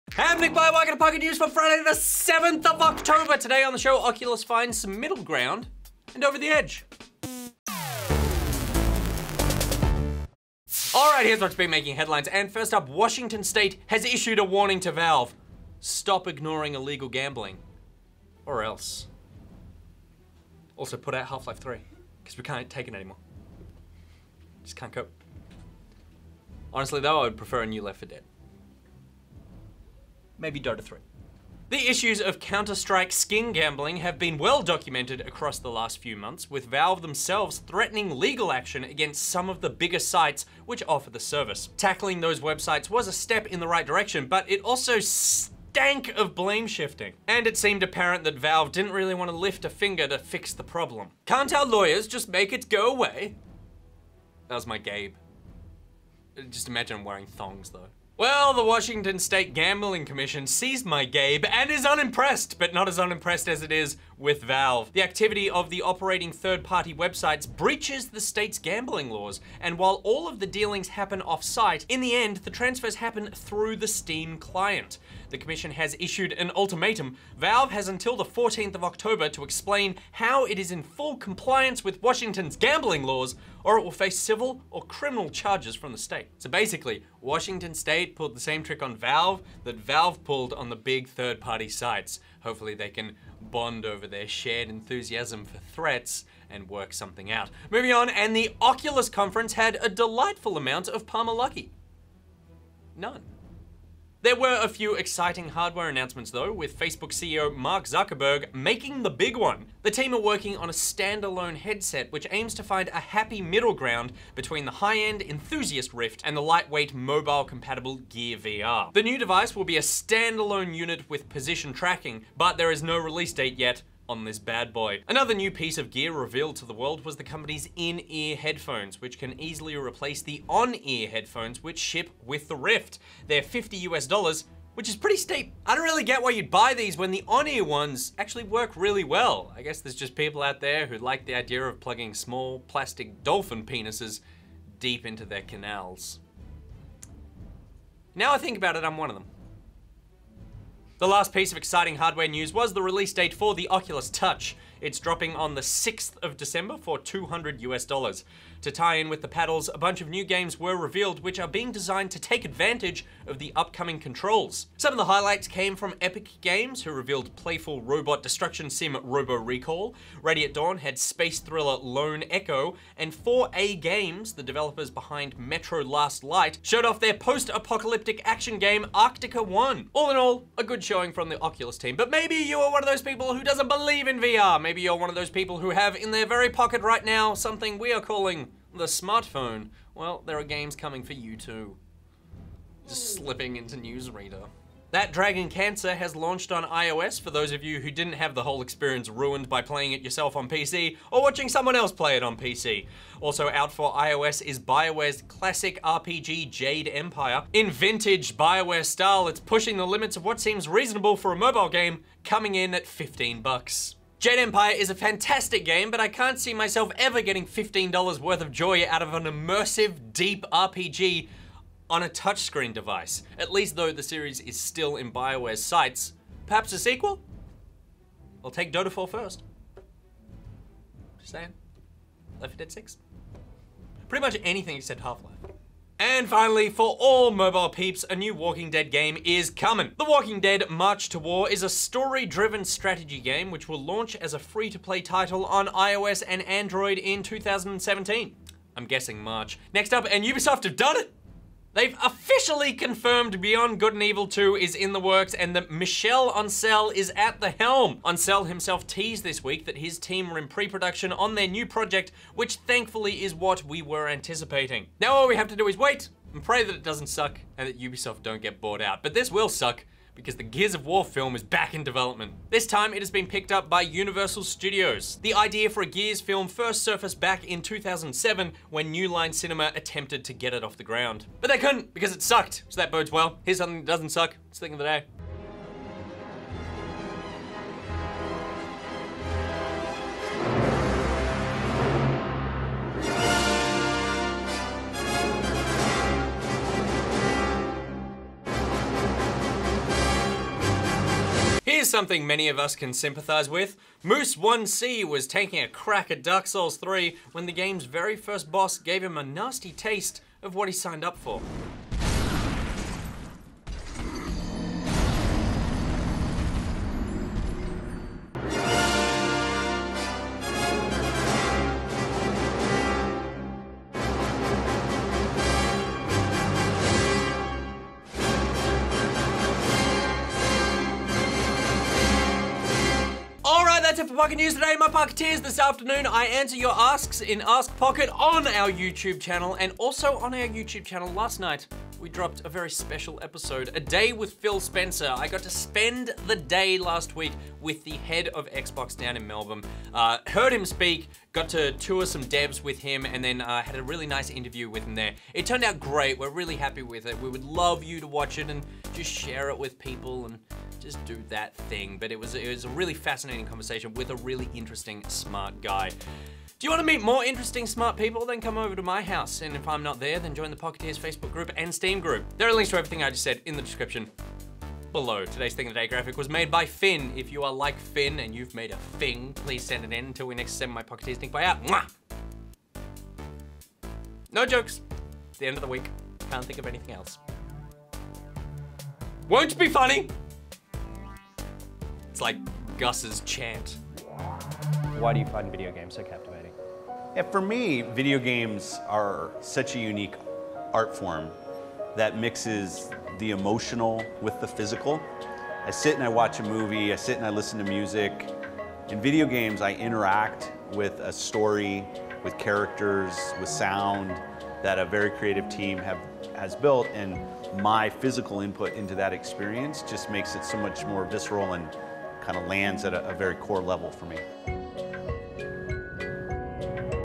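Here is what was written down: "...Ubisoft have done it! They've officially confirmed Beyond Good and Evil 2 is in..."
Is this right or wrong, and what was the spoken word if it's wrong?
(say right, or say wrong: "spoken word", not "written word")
right.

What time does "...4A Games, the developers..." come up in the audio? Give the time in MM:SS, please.
02:53.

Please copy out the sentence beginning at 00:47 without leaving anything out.
And it seemed apparent that Valve didn't really want to lift a finger to fix the problem.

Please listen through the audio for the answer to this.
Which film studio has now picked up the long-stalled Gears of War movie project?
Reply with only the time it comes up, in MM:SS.
04:33.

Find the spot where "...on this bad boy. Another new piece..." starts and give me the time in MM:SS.
02:04.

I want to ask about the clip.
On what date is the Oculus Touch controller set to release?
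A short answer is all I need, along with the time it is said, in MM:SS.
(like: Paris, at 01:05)
6th of December, at 02:35.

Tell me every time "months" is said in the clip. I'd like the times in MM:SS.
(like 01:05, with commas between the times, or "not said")
00:36.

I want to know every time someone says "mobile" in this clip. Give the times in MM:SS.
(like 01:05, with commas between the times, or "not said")
01:56, 03:31, 03:57.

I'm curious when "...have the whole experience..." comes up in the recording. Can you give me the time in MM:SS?
03:18.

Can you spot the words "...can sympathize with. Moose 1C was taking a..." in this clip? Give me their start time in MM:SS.
05:02.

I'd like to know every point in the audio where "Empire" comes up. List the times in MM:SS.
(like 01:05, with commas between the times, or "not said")
03:26, 03:34.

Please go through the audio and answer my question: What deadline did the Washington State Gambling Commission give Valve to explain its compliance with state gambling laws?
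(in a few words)
14th of October.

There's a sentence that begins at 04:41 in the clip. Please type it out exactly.
But they couldn't because it sucked, so that bodes well.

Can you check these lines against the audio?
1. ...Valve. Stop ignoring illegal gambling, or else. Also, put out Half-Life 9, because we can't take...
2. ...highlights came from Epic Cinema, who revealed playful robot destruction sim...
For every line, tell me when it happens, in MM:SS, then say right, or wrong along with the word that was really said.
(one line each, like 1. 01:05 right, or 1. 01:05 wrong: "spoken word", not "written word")
1. 00:14 wrong: "3", not "9"
2. 02:45 wrong: "Games", not "Cinema".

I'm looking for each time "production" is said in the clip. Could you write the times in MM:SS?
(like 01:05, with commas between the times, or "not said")
04:20.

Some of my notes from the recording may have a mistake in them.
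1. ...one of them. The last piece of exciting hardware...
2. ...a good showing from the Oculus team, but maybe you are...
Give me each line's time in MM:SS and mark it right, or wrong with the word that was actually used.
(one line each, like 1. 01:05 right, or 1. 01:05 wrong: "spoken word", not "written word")
1. 02:28 right
2. 03:00 right.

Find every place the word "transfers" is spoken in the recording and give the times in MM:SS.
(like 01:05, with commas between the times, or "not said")
01:12.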